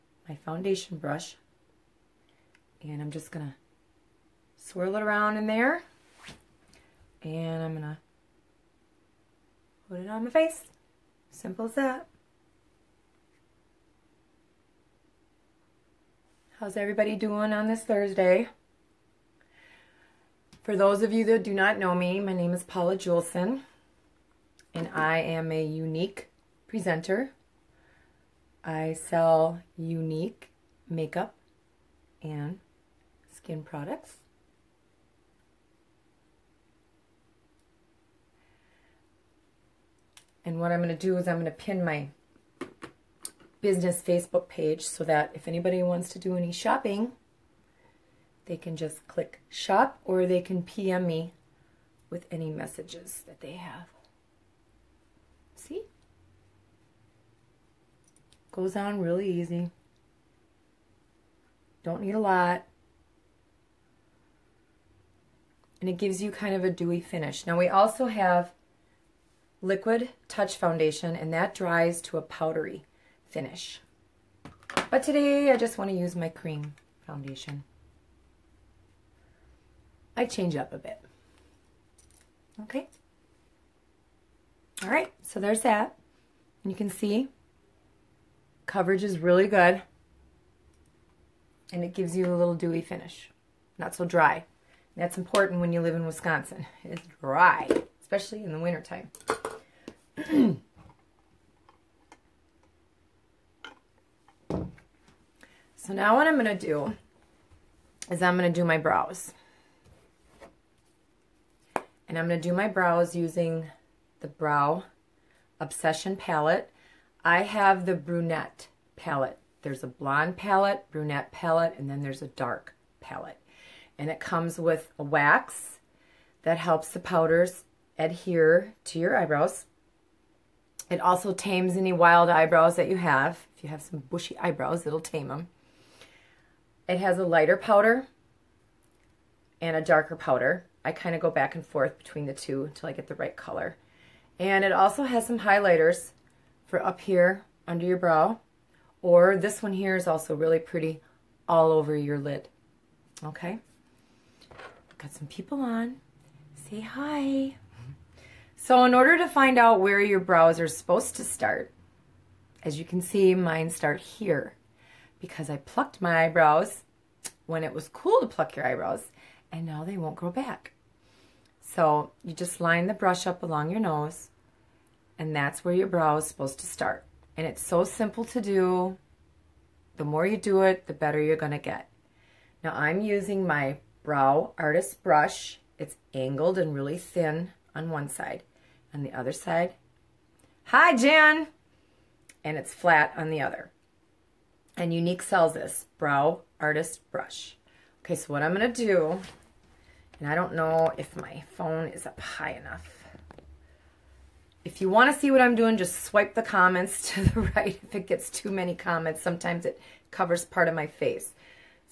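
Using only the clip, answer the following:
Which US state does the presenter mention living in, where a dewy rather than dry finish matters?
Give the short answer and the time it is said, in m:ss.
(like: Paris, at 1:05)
Wisconsin, at 1:36.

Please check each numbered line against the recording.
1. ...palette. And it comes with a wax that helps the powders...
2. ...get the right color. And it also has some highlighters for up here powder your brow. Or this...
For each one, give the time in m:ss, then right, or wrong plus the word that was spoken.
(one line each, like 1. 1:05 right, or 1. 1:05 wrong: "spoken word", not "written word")
1. 2:03 right
2. 2:22 wrong: "under", not "powder".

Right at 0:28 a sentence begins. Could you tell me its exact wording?
I sell Younique makeup and skin products.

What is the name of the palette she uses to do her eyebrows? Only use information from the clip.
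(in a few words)
Brow Obsession.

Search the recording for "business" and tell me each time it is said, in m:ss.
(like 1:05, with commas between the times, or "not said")
0:43.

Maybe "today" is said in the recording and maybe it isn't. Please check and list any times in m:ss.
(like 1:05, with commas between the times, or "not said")
1:15.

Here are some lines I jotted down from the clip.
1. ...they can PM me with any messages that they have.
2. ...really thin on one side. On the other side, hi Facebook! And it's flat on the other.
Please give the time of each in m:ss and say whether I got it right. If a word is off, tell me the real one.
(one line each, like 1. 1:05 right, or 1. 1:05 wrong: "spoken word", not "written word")
1. 0:50 right
2. 3:06 wrong: "Jan", not "Facebook".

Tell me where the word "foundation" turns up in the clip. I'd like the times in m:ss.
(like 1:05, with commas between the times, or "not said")
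0:00, 1:10, 1:17.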